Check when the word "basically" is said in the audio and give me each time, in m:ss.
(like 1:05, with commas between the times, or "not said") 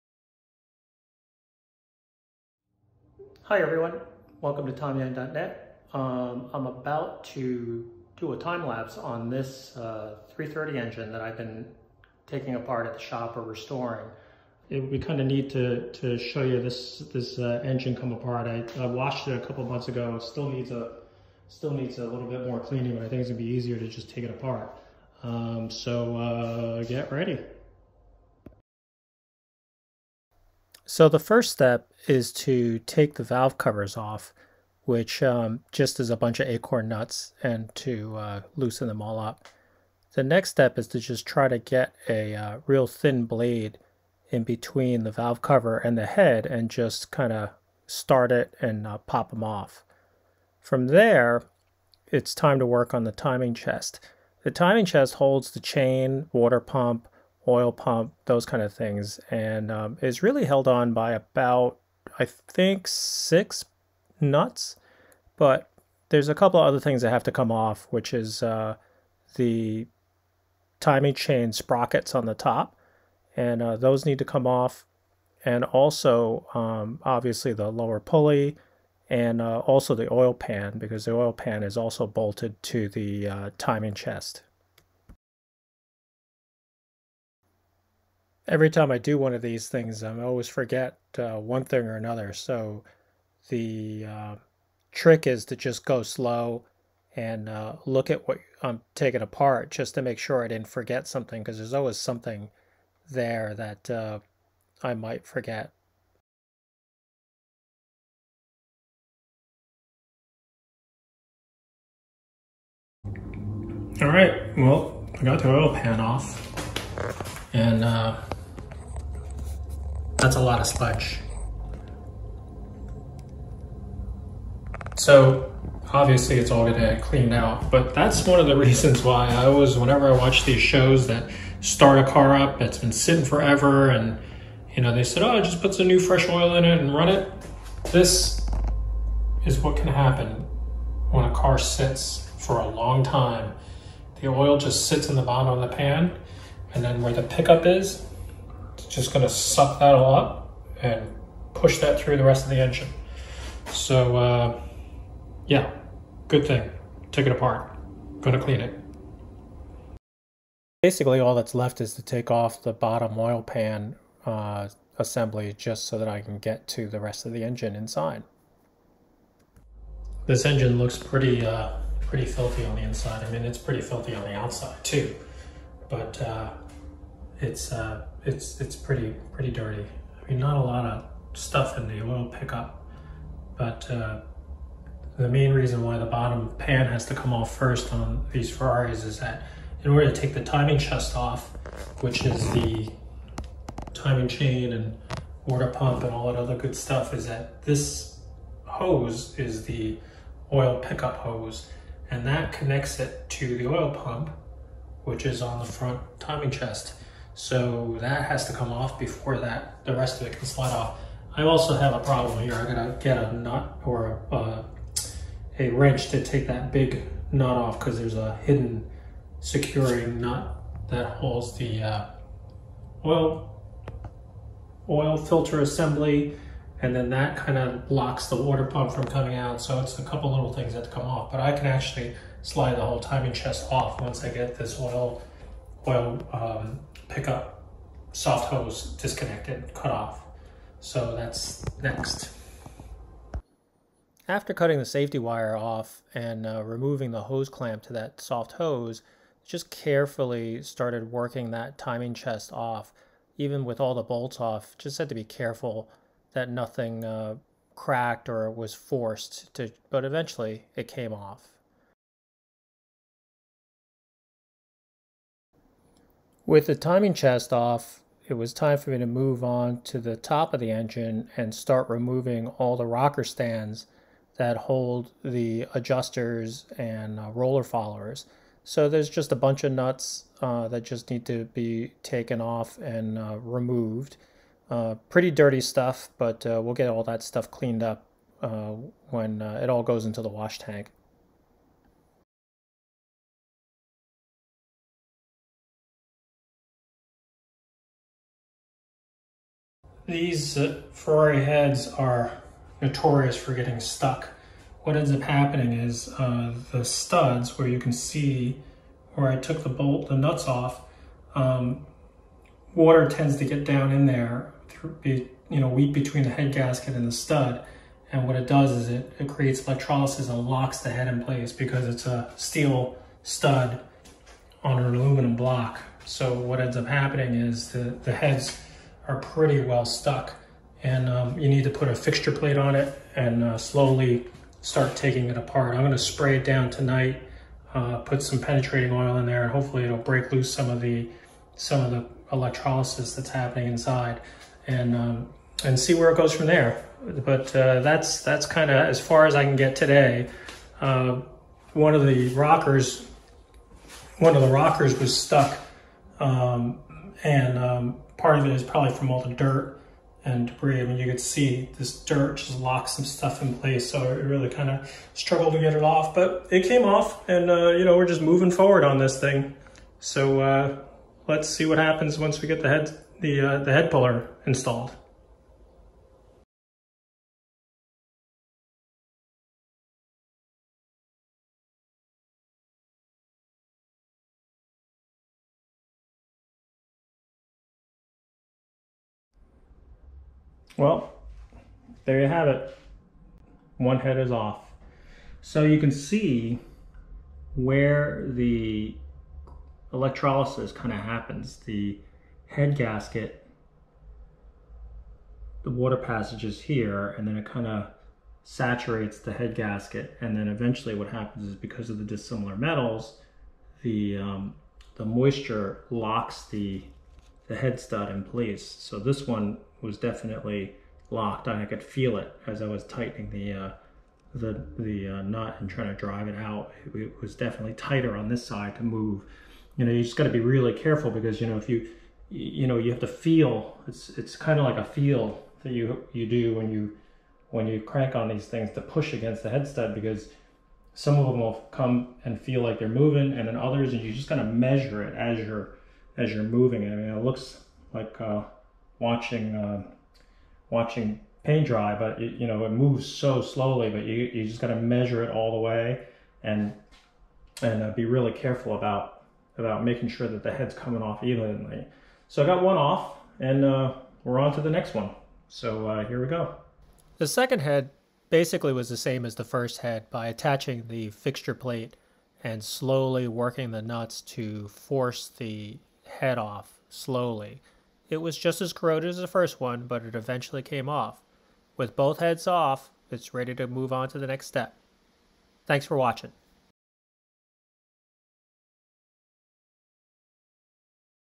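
2:40, 7:48.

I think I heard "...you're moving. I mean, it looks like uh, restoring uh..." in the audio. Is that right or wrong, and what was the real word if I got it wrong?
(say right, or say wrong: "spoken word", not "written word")
wrong: "watching", not "restoring".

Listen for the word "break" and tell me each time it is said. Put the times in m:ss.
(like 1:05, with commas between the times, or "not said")
5:39.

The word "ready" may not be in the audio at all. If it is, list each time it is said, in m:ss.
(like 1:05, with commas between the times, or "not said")
0:27, 8:03.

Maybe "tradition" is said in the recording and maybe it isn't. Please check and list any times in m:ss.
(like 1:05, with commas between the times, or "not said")
not said.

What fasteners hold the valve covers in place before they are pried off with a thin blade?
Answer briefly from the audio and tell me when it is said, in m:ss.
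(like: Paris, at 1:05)
acorn nuts, at 0:36.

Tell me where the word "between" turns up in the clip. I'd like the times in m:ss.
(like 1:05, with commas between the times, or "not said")
0:44, 5:15.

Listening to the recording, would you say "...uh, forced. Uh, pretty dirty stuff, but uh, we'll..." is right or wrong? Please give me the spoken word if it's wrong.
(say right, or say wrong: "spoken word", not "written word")
wrong: "removed", not "forced".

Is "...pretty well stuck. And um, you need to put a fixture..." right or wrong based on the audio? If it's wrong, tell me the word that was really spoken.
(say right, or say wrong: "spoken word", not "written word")
right.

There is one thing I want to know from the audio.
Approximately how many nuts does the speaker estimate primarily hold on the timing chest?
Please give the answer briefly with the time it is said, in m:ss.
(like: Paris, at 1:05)
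6, at 1:02.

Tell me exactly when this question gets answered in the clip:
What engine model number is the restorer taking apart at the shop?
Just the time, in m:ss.
0:10.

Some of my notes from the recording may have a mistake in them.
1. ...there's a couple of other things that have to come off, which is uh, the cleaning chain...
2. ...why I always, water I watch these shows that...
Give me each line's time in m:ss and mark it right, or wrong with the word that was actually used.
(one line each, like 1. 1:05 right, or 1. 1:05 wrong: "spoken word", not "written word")
1. 1:06 wrong: "timing", not "cleaning"
2. 2:09 wrong: "whenever", not "water".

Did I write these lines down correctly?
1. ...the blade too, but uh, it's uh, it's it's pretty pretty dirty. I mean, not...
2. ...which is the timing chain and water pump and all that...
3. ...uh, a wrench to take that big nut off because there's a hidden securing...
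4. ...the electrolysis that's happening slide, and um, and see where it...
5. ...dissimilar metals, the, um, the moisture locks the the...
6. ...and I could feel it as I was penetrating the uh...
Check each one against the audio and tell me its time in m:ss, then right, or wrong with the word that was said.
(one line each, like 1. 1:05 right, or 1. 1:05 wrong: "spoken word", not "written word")
1. 2:54 wrong: "outside", not "blade"
2. 3:12 right
3. 3:34 right
4. 5:41 wrong: "inside", not "slide"
5. 6:52 right
6. 7:01 wrong: "tightening", not "penetrating".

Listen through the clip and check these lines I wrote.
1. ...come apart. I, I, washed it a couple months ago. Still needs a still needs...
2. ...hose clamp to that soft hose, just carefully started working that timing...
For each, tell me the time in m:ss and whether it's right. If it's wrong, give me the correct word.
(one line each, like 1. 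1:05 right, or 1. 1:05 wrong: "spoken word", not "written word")
1. 0:17 right
2. 4:07 right.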